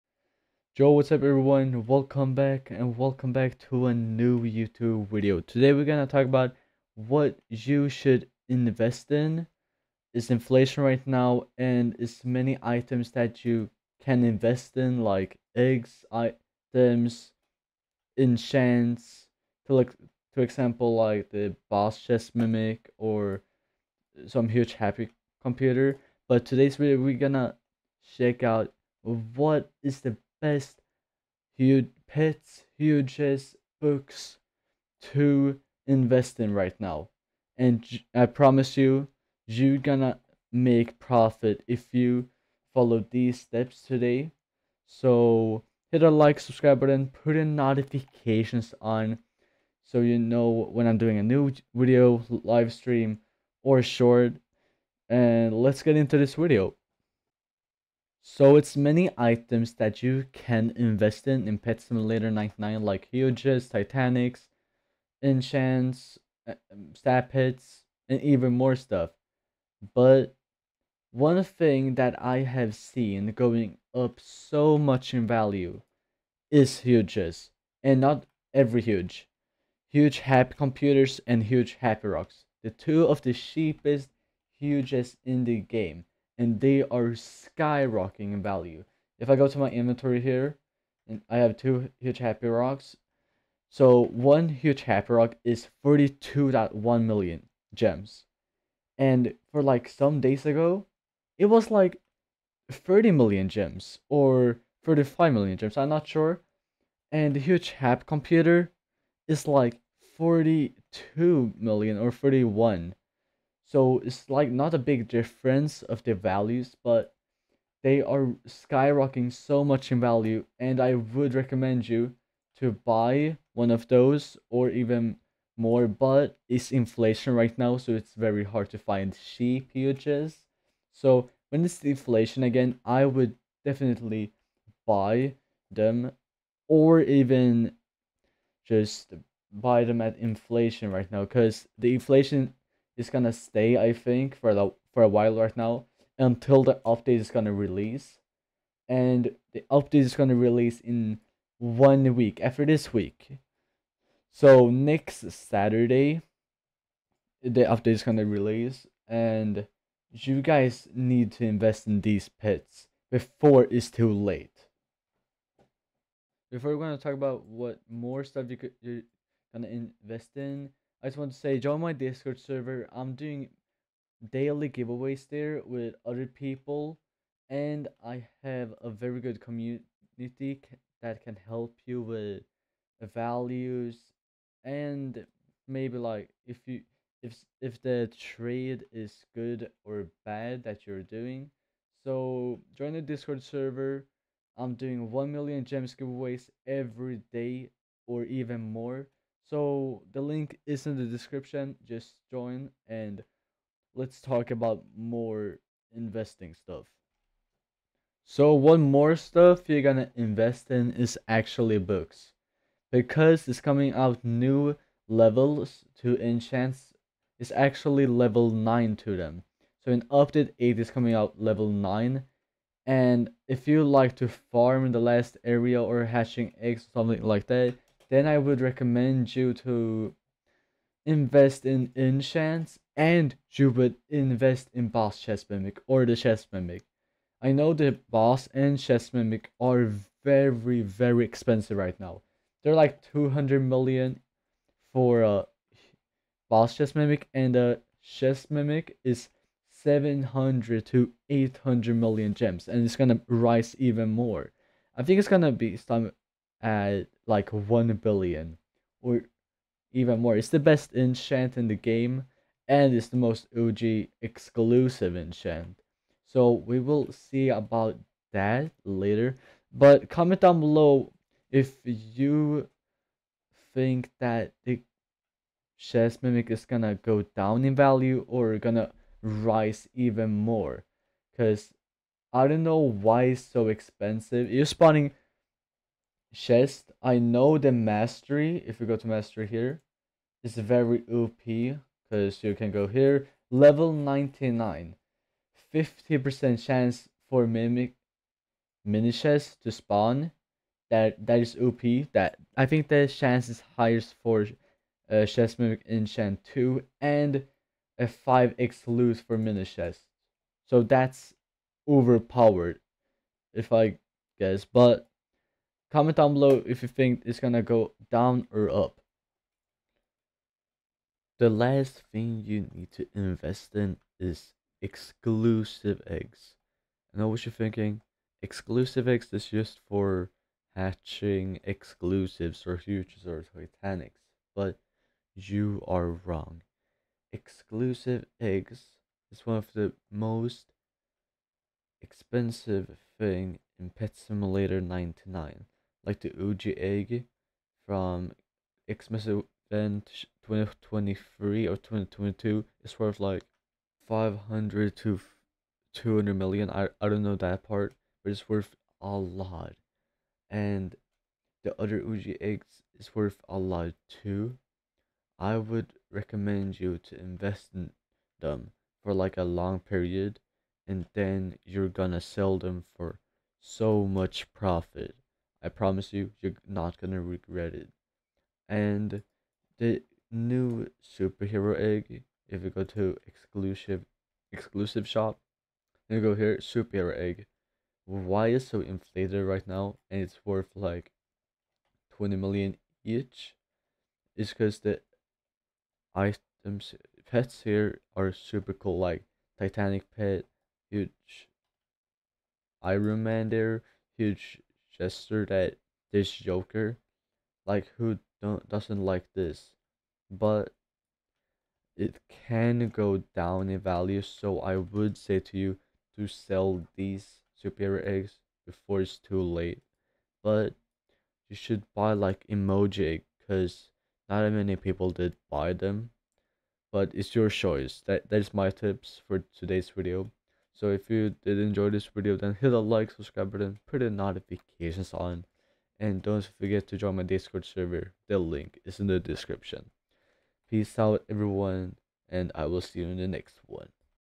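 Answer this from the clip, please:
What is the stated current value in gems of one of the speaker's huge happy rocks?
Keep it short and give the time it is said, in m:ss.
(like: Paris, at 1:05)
42.1 million gems, at 1:35.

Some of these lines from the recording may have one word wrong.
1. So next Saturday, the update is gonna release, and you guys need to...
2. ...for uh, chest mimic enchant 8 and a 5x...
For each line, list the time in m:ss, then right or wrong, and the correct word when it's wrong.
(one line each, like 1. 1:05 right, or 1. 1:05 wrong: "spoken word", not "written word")
1. 2:34 right
2. 5:04 wrong: "2", not "8".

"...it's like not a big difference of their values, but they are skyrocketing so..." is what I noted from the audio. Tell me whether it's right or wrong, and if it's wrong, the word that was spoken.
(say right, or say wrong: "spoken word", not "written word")
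right.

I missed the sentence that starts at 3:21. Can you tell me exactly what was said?
Just join and let's talk about more investing stuff.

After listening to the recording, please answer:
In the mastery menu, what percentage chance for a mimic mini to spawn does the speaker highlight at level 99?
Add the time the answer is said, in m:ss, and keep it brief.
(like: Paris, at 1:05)
50%, at 4:55.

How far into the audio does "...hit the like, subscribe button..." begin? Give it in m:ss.
7:12.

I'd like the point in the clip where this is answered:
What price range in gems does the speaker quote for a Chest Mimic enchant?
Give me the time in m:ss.
4:09.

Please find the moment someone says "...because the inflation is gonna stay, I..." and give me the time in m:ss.
2:21.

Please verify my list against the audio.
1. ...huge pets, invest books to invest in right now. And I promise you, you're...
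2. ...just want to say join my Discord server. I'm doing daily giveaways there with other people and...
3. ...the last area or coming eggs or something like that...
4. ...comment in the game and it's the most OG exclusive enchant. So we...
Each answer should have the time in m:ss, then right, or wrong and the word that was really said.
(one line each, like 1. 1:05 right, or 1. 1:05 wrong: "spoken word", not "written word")
1. 0:31 wrong: "hugest", not "invest"
2. 2:51 right
3. 3:44 wrong: "hatching", not "coming"
4. 4:20 wrong: "enchant", not "comment".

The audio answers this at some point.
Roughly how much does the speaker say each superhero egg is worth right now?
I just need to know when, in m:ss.
6:32.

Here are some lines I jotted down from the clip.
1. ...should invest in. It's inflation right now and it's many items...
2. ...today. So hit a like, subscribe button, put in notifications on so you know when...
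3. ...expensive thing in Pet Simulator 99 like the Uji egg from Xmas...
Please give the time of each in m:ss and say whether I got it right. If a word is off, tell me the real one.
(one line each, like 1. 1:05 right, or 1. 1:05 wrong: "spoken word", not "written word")
1. 0:07 right
2. 0:43 right
3. 5:42 right.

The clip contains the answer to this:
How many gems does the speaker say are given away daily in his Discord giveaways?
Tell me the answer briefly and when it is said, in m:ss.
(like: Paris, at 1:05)
1 million gems, at 3:15.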